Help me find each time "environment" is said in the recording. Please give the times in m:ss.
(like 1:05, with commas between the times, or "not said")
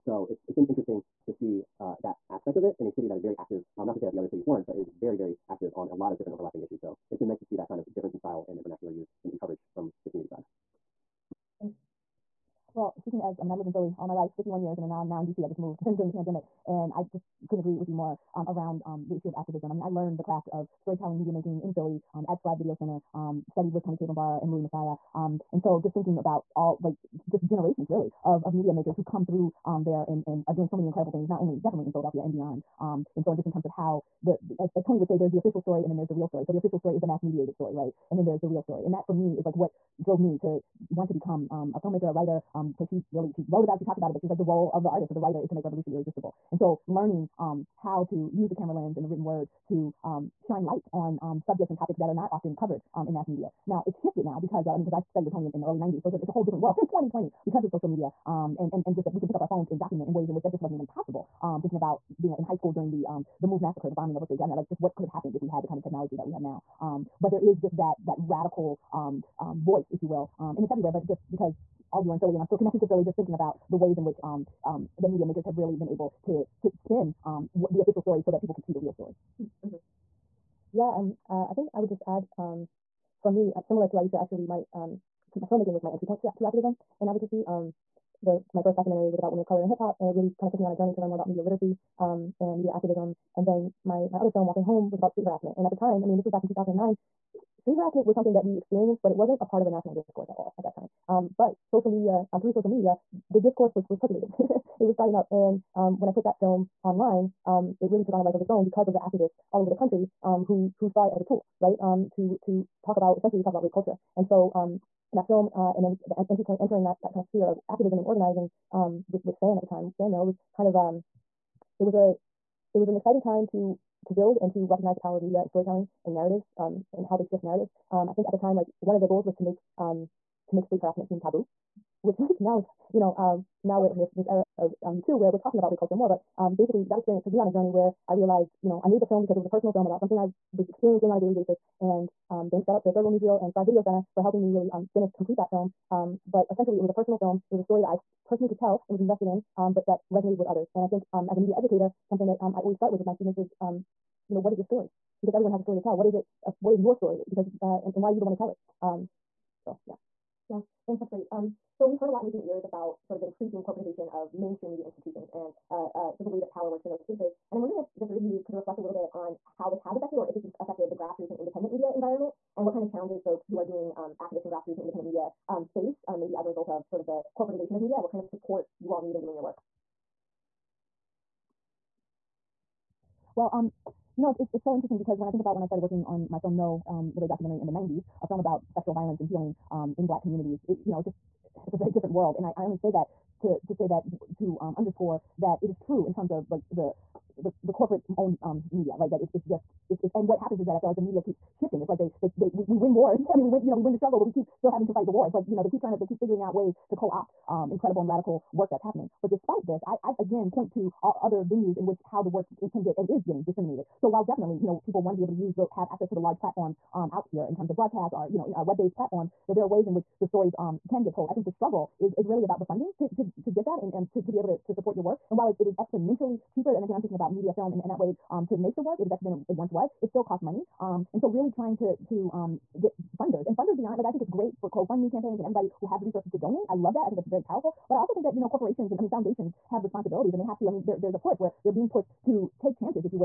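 2:51.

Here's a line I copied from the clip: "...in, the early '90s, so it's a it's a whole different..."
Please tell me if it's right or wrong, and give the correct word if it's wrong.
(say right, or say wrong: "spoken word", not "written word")
right.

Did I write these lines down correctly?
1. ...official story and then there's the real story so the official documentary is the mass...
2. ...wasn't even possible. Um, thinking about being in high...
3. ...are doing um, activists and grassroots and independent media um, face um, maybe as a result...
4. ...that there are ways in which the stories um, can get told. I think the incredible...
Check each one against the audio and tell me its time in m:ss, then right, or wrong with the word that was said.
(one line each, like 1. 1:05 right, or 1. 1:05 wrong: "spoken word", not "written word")
1. 0:35 wrong: "story", not "documentary"
2. 1:00 right
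3. 2:53 right
4. 3:39 wrong: "struggle", not "incredible".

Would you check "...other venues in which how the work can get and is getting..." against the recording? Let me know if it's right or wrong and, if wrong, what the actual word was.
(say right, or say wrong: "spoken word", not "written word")
right.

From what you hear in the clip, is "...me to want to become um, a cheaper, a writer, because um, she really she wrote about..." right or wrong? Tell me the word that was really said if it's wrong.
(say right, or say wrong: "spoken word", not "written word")
wrong: "filmmaker", not "cheaper".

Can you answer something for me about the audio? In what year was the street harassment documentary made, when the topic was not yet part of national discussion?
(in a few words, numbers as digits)
2009.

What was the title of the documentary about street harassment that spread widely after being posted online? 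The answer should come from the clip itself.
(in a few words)
Walking Home.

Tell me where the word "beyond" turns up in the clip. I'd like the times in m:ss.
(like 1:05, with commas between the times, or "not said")
0:32, 3:53.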